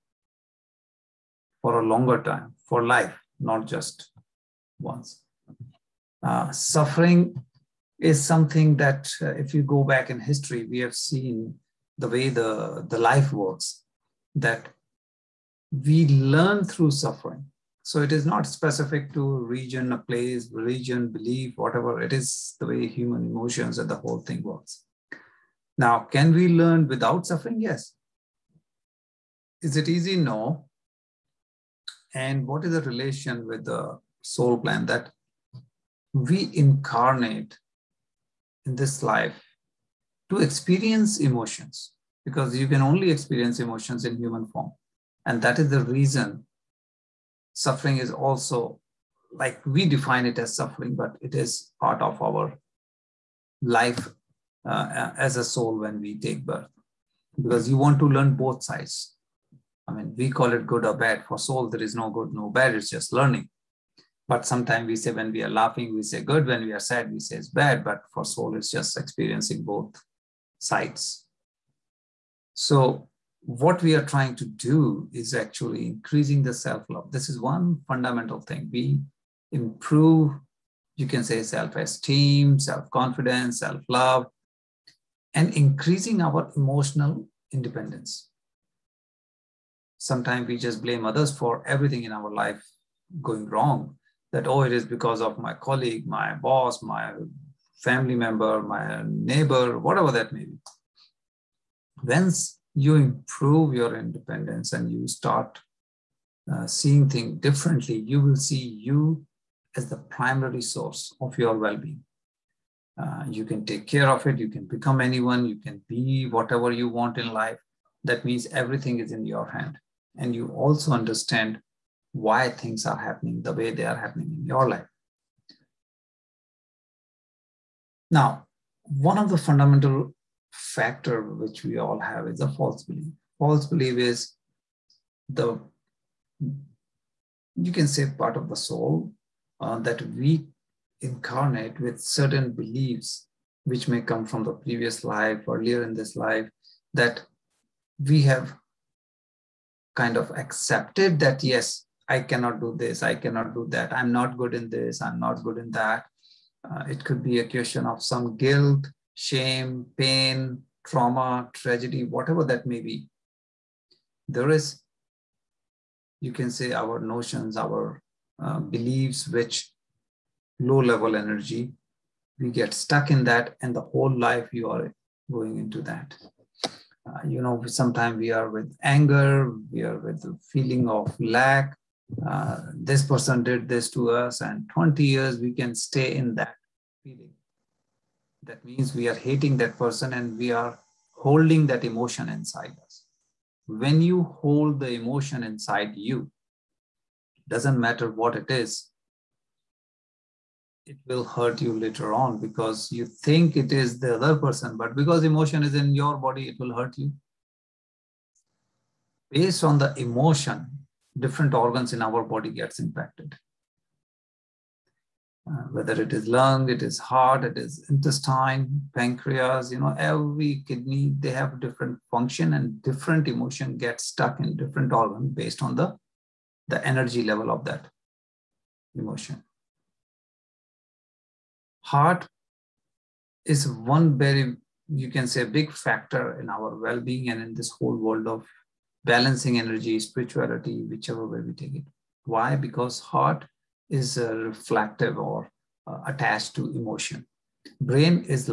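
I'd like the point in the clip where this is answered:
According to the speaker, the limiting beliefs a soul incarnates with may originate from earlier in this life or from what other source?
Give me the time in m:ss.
2:24.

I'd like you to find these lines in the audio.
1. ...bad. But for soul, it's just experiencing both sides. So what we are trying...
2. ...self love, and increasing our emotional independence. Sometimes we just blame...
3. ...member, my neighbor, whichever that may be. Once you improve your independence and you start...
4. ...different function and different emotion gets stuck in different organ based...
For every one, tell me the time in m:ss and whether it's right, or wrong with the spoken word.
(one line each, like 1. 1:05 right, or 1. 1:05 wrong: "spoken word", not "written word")
1. 1:07 right
2. 1:23 right
3. 1:38 wrong: "whatever", not "whichever"
4. 3:41 right.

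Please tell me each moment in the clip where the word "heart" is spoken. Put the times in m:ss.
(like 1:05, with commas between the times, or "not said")
3:36, 3:51, 4:02.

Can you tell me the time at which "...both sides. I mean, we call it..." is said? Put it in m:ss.
0:58.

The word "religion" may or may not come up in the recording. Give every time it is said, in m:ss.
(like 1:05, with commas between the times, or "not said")
0:20.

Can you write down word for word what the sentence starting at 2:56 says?
Uh, you know, sometimes we are with anger, we are with the feeling of lack.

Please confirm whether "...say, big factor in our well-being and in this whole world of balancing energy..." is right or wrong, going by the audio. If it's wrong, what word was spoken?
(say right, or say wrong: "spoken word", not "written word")
right.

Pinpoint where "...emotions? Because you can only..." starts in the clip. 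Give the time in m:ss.
0:41.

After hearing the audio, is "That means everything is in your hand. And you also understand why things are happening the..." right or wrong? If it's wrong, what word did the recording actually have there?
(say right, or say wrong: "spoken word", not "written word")
right.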